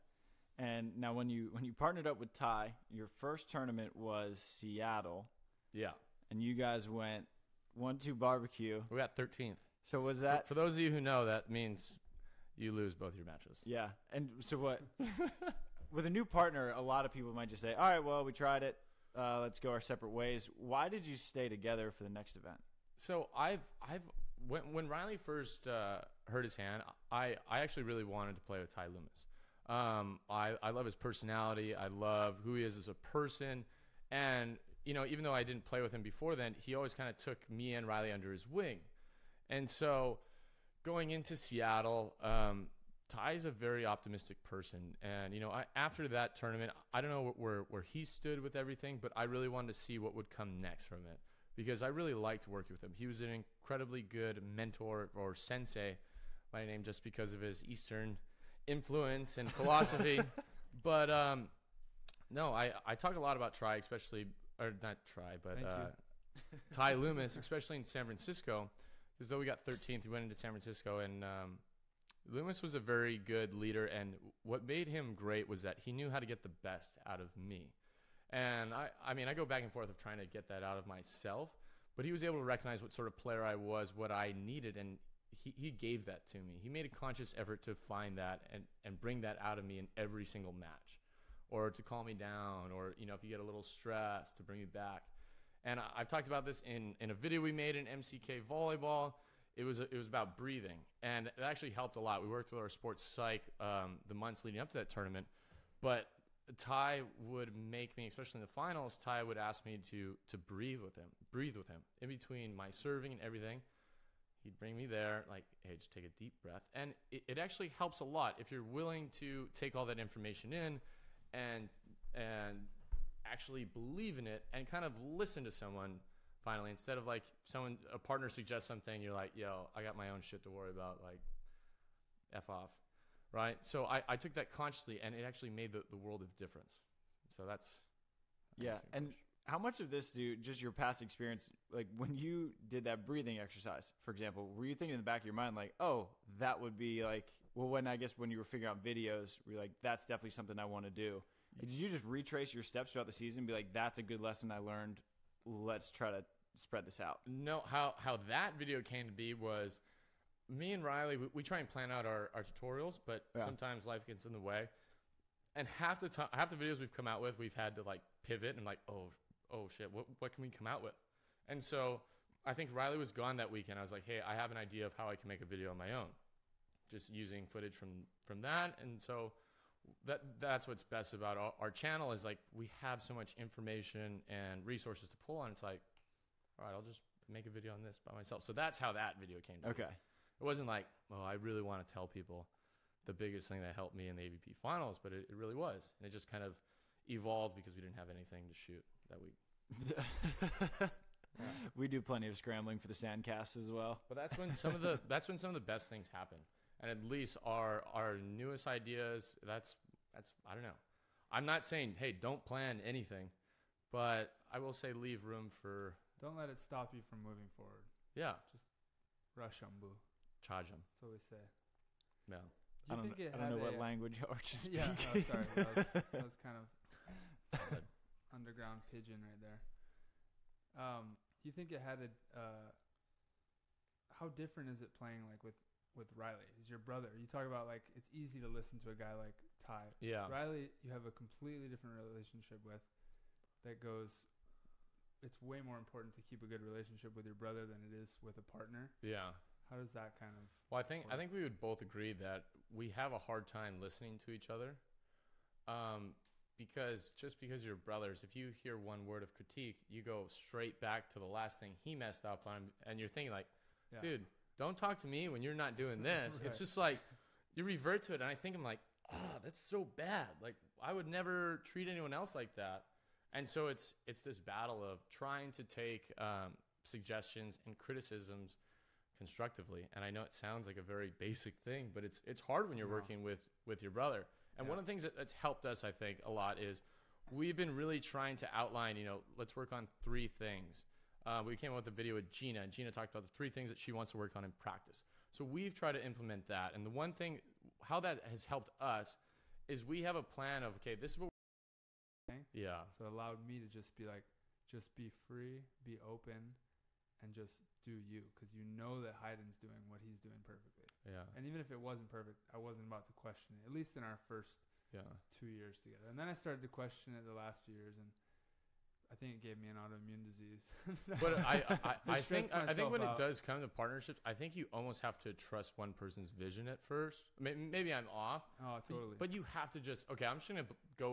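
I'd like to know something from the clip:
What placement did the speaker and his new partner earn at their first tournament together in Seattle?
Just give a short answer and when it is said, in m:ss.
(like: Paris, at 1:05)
13th, at 0:09.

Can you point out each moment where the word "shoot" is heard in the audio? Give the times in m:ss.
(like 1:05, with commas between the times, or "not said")
3:18.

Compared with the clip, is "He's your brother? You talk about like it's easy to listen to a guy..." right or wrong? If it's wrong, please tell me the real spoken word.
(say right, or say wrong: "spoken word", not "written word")
right.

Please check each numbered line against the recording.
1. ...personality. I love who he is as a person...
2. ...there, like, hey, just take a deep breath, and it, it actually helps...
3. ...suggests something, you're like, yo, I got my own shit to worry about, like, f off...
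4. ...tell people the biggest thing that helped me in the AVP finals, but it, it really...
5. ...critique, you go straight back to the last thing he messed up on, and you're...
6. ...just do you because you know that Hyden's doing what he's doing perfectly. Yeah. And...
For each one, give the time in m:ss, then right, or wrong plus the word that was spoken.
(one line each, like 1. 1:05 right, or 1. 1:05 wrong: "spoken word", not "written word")
1. 0:30 right
2. 1:54 right
3. 2:08 right
4. 3:11 right
5. 4:19 right
6. 5:07 right.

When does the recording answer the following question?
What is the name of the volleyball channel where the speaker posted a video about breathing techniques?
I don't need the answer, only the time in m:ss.
1:37.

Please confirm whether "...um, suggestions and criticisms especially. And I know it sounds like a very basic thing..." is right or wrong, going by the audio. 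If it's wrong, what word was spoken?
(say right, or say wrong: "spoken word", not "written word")
wrong: "constructively", not "especially".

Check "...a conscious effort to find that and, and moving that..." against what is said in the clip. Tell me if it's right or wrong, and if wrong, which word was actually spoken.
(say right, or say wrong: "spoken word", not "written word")
wrong: "bring", not "moving".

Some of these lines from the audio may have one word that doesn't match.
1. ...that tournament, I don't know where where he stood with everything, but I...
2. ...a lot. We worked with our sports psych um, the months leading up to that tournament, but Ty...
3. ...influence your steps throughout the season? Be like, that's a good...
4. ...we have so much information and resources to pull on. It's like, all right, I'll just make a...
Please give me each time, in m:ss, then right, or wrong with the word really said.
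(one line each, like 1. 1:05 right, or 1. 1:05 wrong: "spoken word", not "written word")
1. 0:46 right
2. 1:41 right
3. 2:32 wrong: "retrace", not "influence"
4. 3:02 right.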